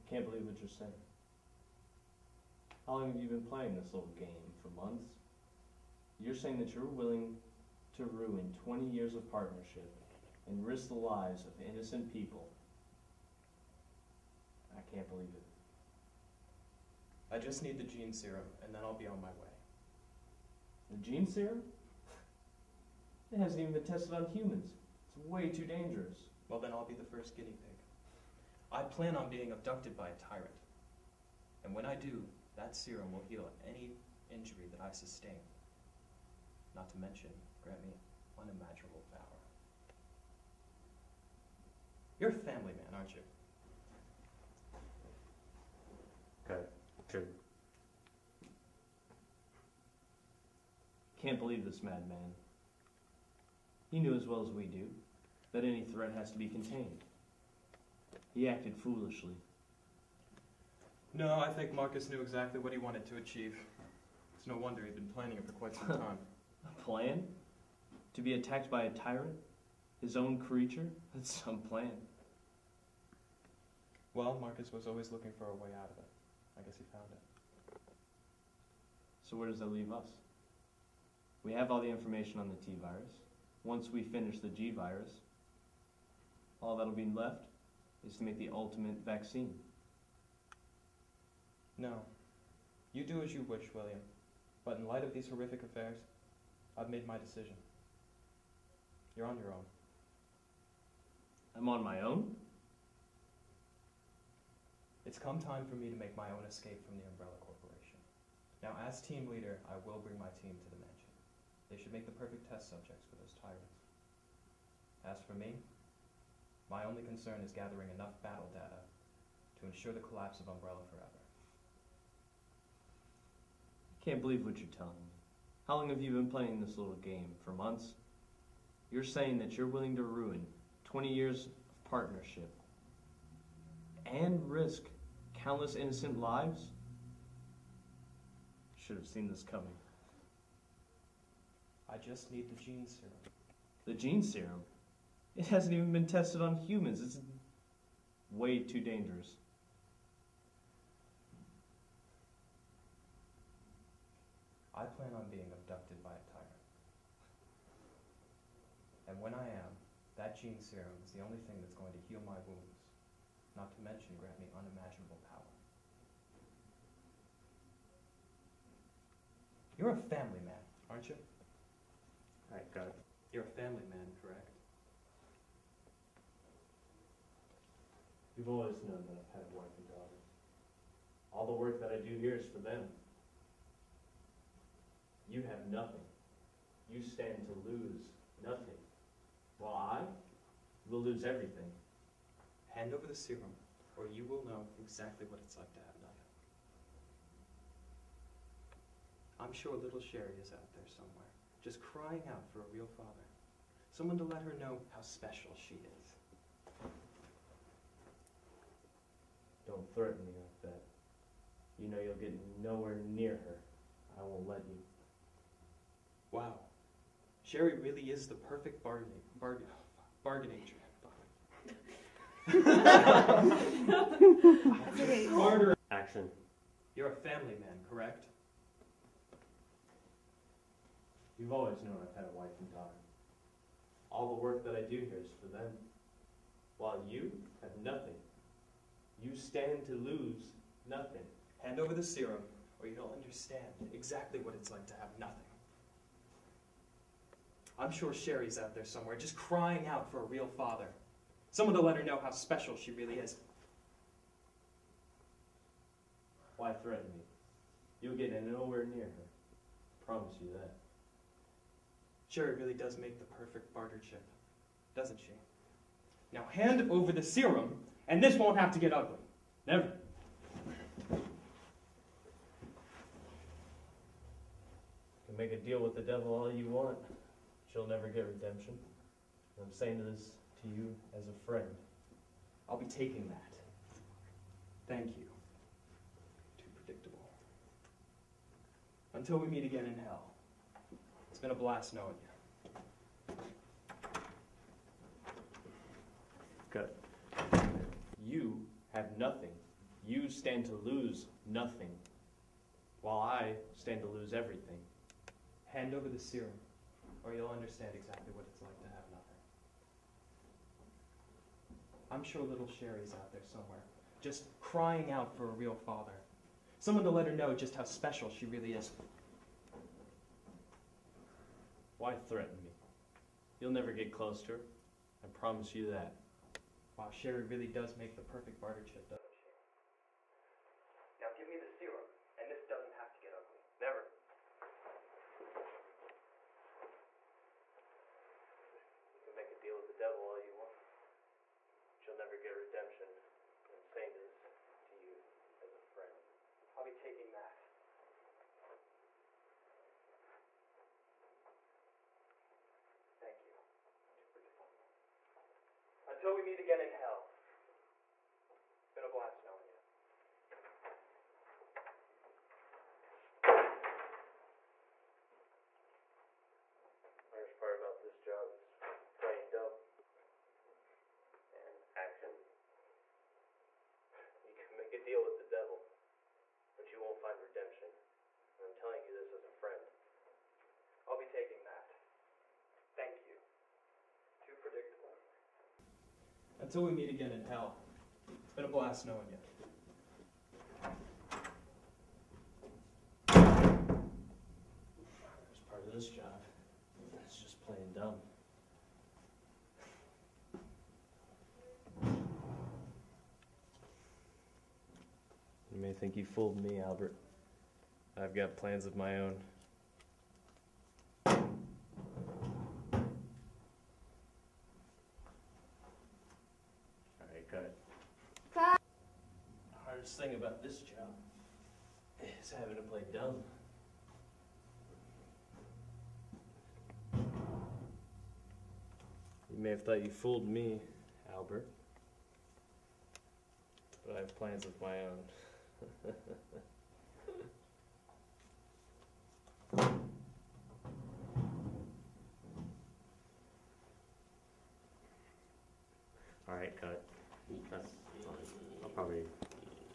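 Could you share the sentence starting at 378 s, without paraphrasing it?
And I'm telling you this as a friend.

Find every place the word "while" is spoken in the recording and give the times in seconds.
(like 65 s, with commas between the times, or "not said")
189 s, 236 s, 303 s.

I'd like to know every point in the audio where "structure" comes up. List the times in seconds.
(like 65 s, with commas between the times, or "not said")
not said.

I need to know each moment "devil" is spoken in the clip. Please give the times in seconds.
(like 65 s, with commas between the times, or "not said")
276 s, 340 s, 375 s.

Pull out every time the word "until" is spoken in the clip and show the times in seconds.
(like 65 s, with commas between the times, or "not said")
289 s, 356 s, 386 s.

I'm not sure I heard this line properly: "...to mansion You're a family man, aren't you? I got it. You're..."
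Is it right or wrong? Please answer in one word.
wrong.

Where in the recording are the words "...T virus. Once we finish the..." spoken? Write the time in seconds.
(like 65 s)
82 s.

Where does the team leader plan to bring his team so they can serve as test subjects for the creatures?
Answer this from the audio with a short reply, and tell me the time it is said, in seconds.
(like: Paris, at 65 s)
the mansion, at 110 s.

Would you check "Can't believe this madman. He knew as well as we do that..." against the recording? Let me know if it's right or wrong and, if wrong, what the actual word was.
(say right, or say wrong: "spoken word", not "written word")
right.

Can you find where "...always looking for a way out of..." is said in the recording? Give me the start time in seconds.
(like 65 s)
74 s.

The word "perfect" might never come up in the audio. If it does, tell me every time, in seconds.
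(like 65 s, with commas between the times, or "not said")
112 s, 218 s, 263 s, 328 s.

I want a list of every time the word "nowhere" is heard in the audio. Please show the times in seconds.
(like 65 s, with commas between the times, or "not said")
212 s, 258 s.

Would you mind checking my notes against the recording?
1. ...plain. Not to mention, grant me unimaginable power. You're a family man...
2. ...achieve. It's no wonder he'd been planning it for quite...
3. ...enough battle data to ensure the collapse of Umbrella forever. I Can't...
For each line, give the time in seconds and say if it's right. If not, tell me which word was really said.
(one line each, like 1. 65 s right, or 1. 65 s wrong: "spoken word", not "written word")
1. 34 s wrong: "sustain", not "plain"
2. 63 s right
3. 117 s right.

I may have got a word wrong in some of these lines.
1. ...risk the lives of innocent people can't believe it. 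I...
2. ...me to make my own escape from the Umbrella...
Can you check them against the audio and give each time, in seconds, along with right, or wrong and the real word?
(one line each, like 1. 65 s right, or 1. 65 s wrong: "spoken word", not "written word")
1. 10 s right
2. 105 s right.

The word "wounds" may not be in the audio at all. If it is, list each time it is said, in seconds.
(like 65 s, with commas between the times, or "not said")
162 s.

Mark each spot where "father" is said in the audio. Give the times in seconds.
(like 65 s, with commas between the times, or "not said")
202 s, 250 s, 315 s.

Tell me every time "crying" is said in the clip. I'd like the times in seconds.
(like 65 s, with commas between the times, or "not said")
201 s, 249 s, 314 s.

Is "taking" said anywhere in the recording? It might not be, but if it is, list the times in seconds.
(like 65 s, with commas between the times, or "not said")
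282 s, 346 s, 381 s.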